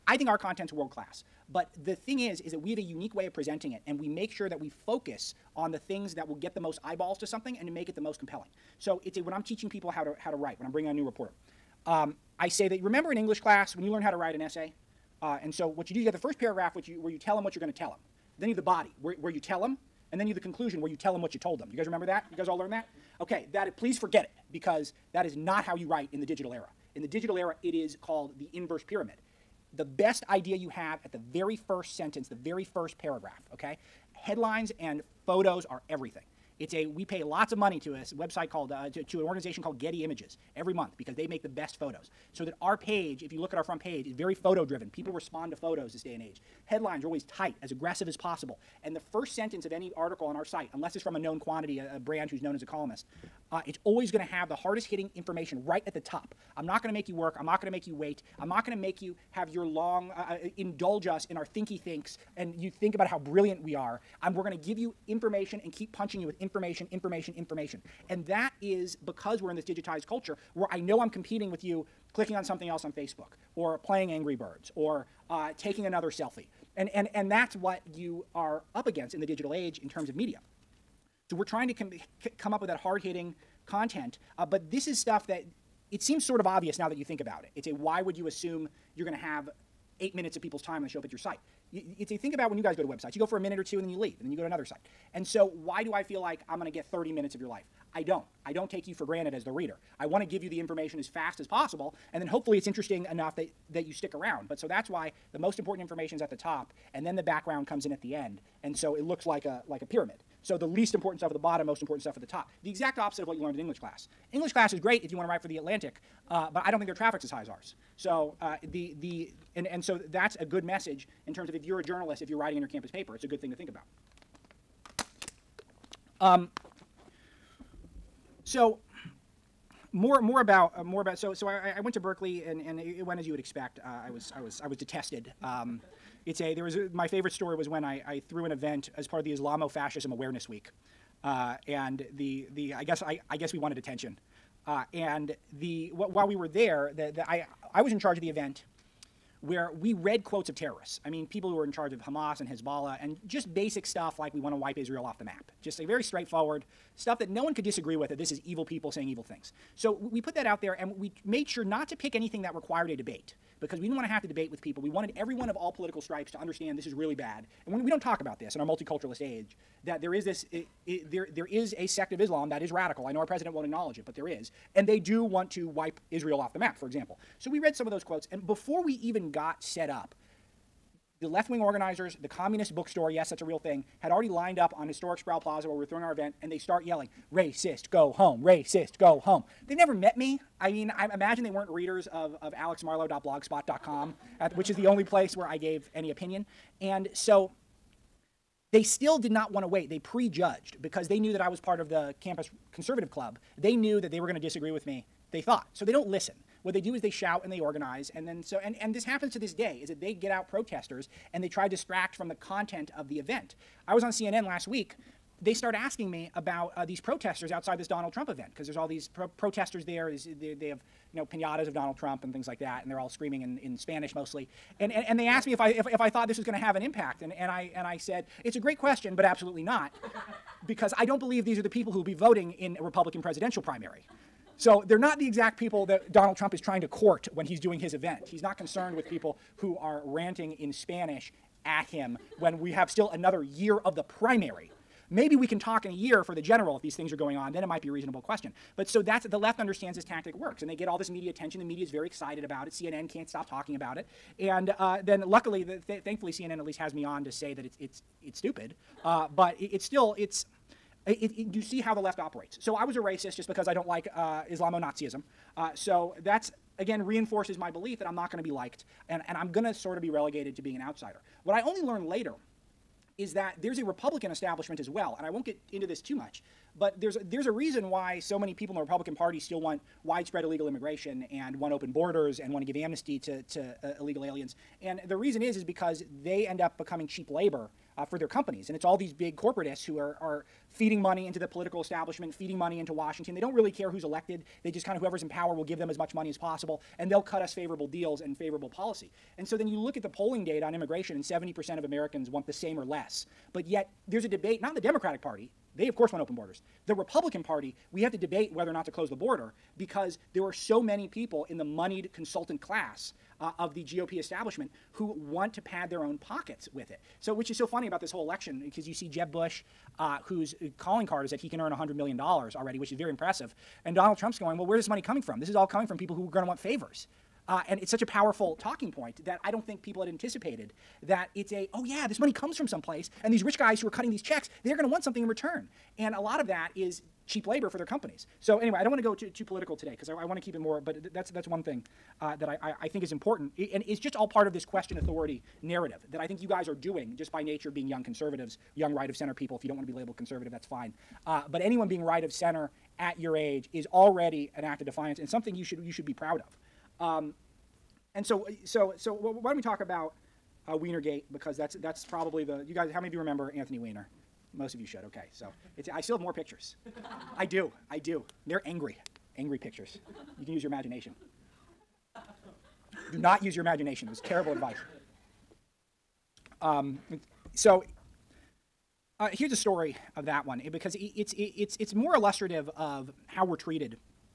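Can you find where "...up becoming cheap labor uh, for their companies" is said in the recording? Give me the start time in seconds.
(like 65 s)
286 s.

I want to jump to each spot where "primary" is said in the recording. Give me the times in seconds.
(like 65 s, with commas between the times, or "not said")
233 s, 244 s.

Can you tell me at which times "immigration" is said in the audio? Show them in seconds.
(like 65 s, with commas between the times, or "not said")
280 s, 300 s.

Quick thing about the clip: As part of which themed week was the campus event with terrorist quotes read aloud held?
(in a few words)
Islamo Fascism Awareness Week.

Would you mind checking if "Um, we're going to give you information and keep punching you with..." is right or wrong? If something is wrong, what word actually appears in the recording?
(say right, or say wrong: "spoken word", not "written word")
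right.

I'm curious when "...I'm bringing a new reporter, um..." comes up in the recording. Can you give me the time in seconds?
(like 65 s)
10 s.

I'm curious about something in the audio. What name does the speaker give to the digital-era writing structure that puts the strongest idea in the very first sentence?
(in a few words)
inverse pyramid.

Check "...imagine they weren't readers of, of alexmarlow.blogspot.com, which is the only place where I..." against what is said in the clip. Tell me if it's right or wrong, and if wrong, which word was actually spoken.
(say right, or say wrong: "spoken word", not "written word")
right.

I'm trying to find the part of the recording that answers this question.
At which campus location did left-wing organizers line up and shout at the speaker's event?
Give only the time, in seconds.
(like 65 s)
185 s.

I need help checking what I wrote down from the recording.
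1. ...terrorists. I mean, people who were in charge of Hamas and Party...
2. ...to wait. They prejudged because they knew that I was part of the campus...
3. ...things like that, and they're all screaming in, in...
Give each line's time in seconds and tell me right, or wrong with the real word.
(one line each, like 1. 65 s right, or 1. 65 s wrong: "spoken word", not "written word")
1. 150 s wrong: "Hezbollah", not "Party"
2. 199 s right
3. 222 s right.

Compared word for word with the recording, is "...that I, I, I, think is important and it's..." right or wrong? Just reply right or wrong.
right.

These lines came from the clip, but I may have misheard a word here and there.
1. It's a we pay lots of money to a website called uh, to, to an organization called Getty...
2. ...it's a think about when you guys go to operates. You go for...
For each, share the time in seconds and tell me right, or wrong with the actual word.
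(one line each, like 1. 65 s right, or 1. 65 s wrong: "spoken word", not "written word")
1. 36 s right
2. 91 s wrong: "websites", not "operates".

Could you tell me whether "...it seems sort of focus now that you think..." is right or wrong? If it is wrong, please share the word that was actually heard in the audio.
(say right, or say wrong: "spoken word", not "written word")
wrong: "obvious", not "focus".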